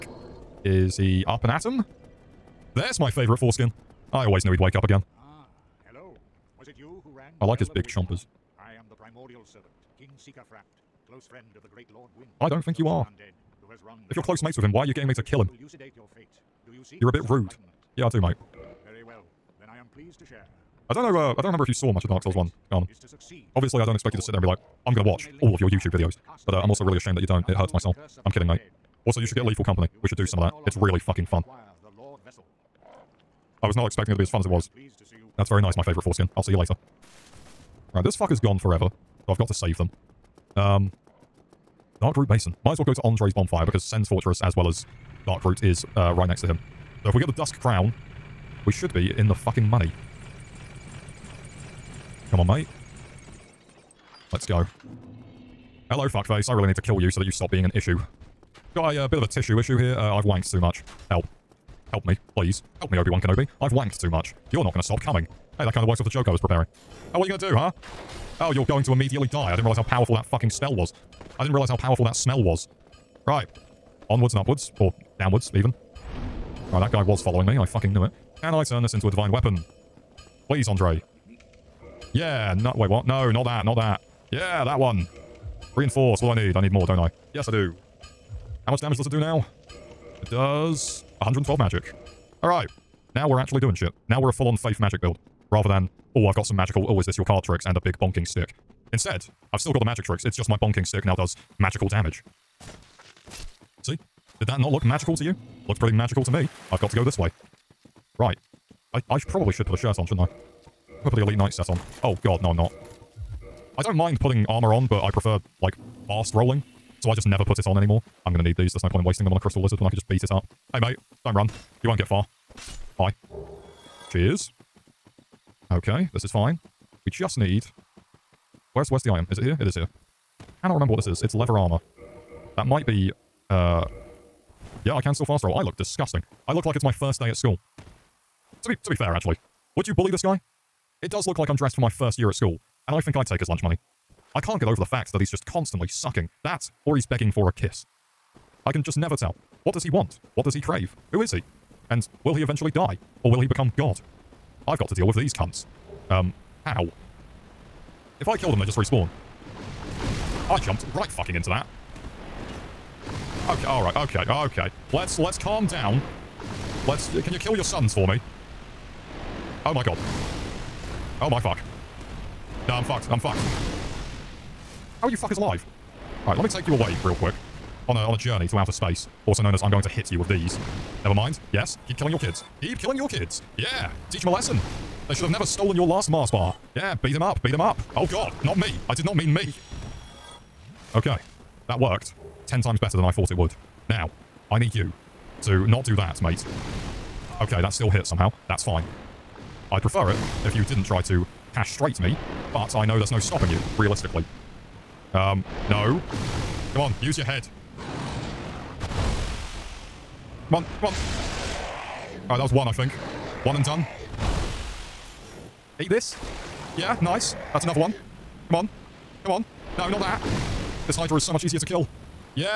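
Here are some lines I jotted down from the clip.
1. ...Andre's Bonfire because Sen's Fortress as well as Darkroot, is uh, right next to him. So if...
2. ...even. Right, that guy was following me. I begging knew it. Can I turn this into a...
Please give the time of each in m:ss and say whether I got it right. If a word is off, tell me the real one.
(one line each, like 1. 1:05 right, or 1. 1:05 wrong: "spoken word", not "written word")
1. 0:43 right
2. 1:15 wrong: "fucking", not "begging".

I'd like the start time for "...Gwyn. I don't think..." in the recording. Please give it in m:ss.
0:12.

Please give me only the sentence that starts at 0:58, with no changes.
Got a uh, bit of a tissue issue here.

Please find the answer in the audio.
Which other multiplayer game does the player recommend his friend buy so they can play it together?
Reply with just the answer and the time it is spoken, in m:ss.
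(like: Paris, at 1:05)
Lethal Company, at 0:29.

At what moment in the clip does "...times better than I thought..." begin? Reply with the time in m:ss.
3:12.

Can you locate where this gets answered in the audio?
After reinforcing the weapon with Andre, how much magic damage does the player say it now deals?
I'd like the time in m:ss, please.
1:31.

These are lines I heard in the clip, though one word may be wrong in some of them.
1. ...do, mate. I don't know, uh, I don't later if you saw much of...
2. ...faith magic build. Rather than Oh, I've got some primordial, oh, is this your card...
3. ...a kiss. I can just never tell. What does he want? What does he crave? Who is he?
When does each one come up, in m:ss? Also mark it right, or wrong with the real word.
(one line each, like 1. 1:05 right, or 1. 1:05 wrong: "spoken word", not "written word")
1. 0:18 wrong: "remember", not "later"
2. 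1:34 wrong: "magical", not "primordial"
3. 2:27 right.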